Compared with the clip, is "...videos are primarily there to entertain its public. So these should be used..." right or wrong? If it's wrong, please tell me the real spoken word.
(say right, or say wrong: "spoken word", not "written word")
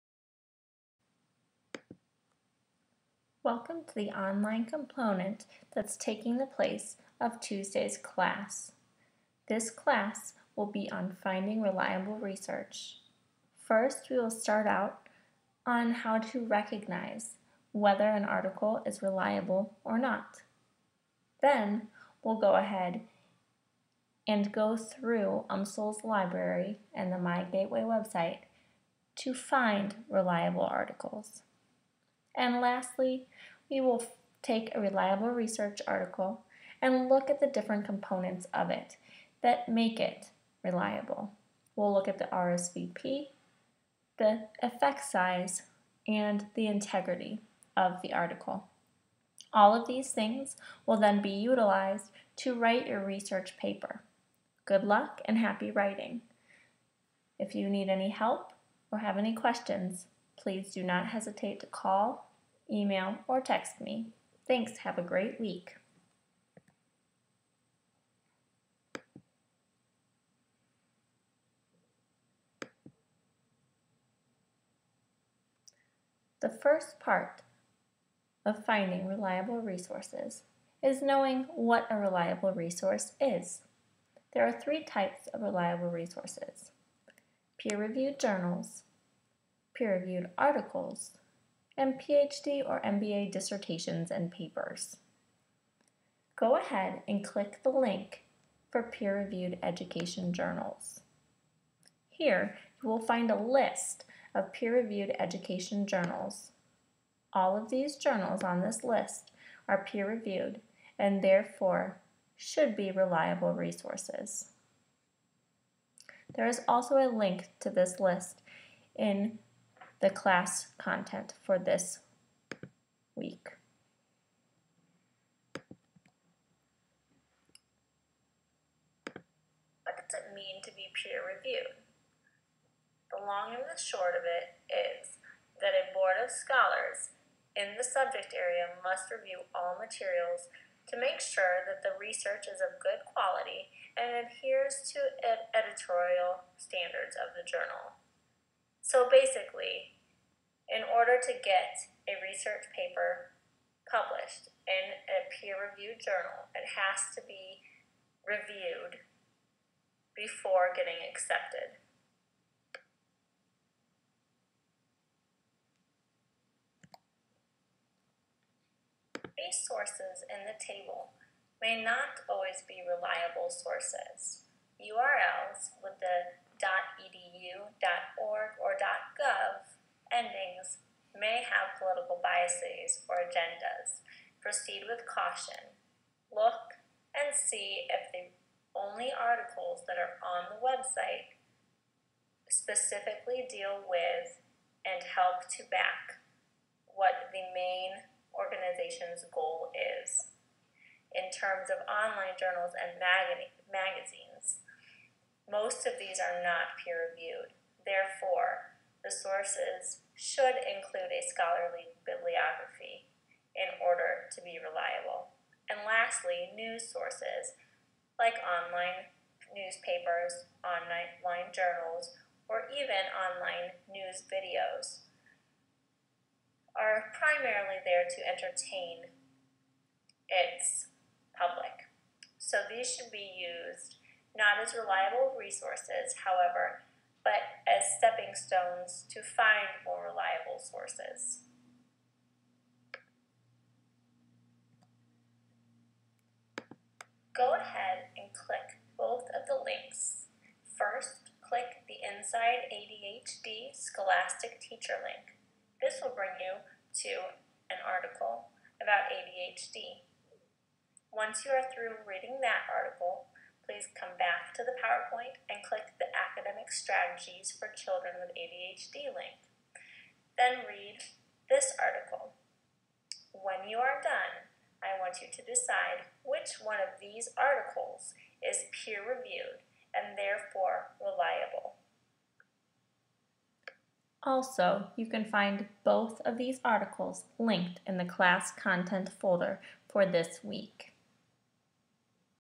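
right.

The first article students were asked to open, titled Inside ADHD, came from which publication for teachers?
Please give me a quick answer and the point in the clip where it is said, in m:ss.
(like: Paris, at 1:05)
Scholastic Teacher, at 4:13.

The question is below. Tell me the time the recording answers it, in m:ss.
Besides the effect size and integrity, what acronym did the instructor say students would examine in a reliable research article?
0:42.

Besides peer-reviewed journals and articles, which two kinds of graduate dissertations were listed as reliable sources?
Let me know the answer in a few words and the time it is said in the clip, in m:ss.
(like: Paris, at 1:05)
PhD or MBA, at 1:31.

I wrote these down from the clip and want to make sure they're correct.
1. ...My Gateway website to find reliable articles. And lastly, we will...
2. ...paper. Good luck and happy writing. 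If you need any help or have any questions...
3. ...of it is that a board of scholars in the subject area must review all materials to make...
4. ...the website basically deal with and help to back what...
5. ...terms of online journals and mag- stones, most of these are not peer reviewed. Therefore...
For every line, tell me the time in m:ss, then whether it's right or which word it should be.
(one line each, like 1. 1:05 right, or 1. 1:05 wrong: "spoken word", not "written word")
1. 0:27 right
2. 0:53 right
3. 2:14 right
4. 3:10 wrong: "specifically", not "basically"
5. 3:21 wrong: "magazines", not "stones".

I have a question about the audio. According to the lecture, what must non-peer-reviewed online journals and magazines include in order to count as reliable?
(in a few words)
scholarly bibliography.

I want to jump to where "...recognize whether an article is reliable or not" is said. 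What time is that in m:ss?
0:16.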